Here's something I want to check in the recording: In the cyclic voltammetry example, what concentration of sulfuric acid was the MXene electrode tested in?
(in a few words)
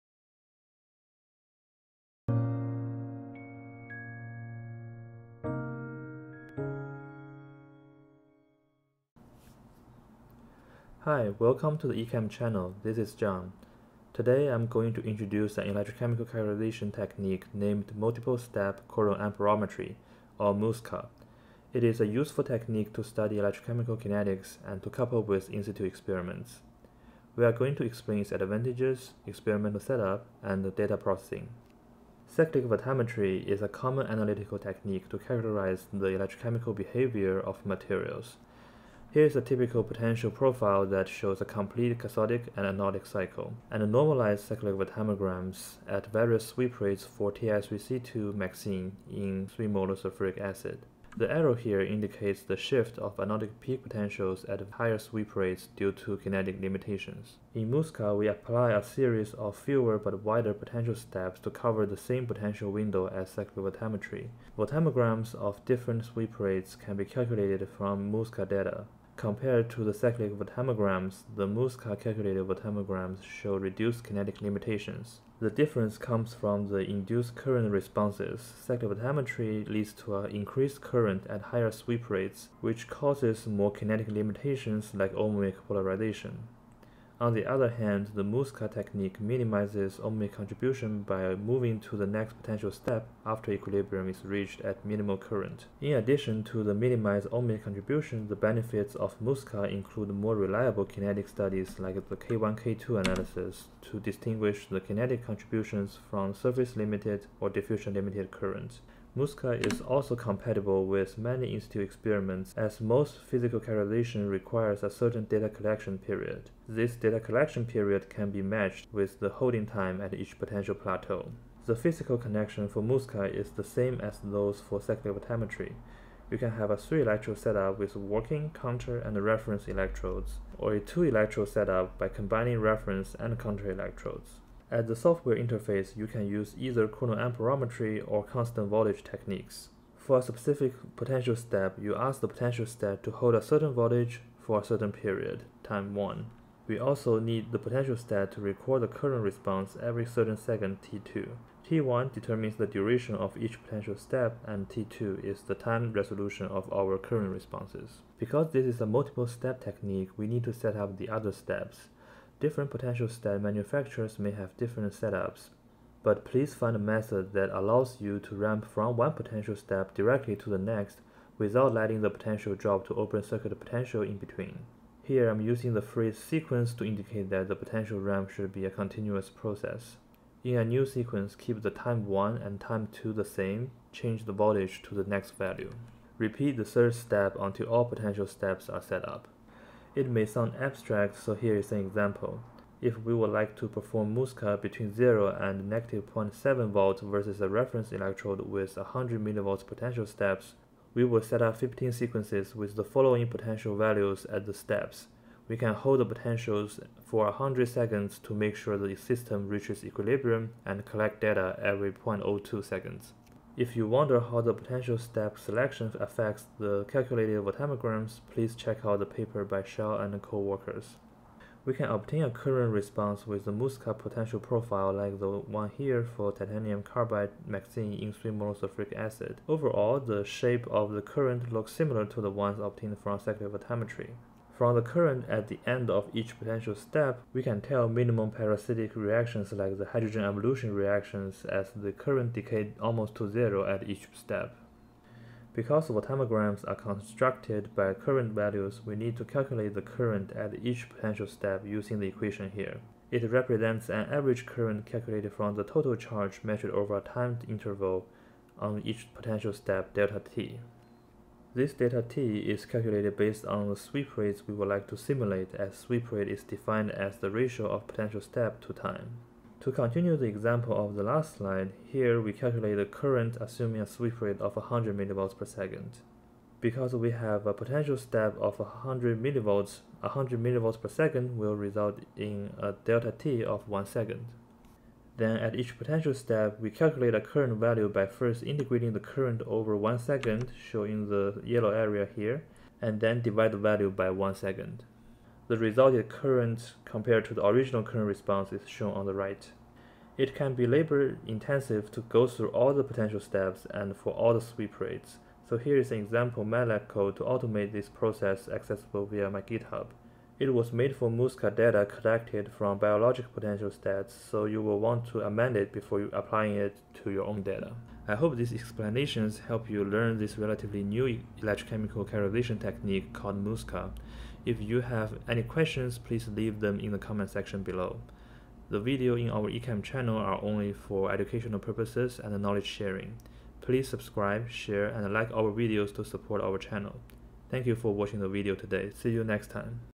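3 molar.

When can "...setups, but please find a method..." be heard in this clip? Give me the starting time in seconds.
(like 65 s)
164 s.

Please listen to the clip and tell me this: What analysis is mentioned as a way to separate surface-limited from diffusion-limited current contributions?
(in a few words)
K1, K2 analysis.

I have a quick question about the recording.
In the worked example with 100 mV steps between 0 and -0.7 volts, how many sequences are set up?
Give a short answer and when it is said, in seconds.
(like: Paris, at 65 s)
15, at 201 s.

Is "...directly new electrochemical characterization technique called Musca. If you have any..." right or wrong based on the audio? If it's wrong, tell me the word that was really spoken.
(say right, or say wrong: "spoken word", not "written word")
wrong: "relatively", not "directly".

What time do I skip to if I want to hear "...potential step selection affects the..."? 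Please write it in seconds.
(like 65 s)
214 s.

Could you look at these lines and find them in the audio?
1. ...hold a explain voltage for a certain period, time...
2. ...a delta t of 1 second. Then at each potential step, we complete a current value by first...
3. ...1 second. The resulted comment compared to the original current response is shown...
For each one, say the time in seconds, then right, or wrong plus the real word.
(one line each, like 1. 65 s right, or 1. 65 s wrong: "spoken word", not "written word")
1. 143 s wrong: "certain", not "explain"
2. 282 s wrong: "calculate", not "complete"
3. 294 s wrong: "current", not "comment".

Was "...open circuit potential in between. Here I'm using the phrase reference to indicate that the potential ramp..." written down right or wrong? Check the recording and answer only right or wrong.
wrong.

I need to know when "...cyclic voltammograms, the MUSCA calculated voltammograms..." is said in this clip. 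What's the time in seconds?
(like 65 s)
69 s.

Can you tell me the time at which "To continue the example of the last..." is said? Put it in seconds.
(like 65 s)
269 s.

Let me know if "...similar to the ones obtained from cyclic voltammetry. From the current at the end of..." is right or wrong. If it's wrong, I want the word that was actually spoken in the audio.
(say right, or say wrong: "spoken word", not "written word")
right.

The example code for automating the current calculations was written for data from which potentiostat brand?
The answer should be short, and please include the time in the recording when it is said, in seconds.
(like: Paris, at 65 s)
BioLogic, at 312 s.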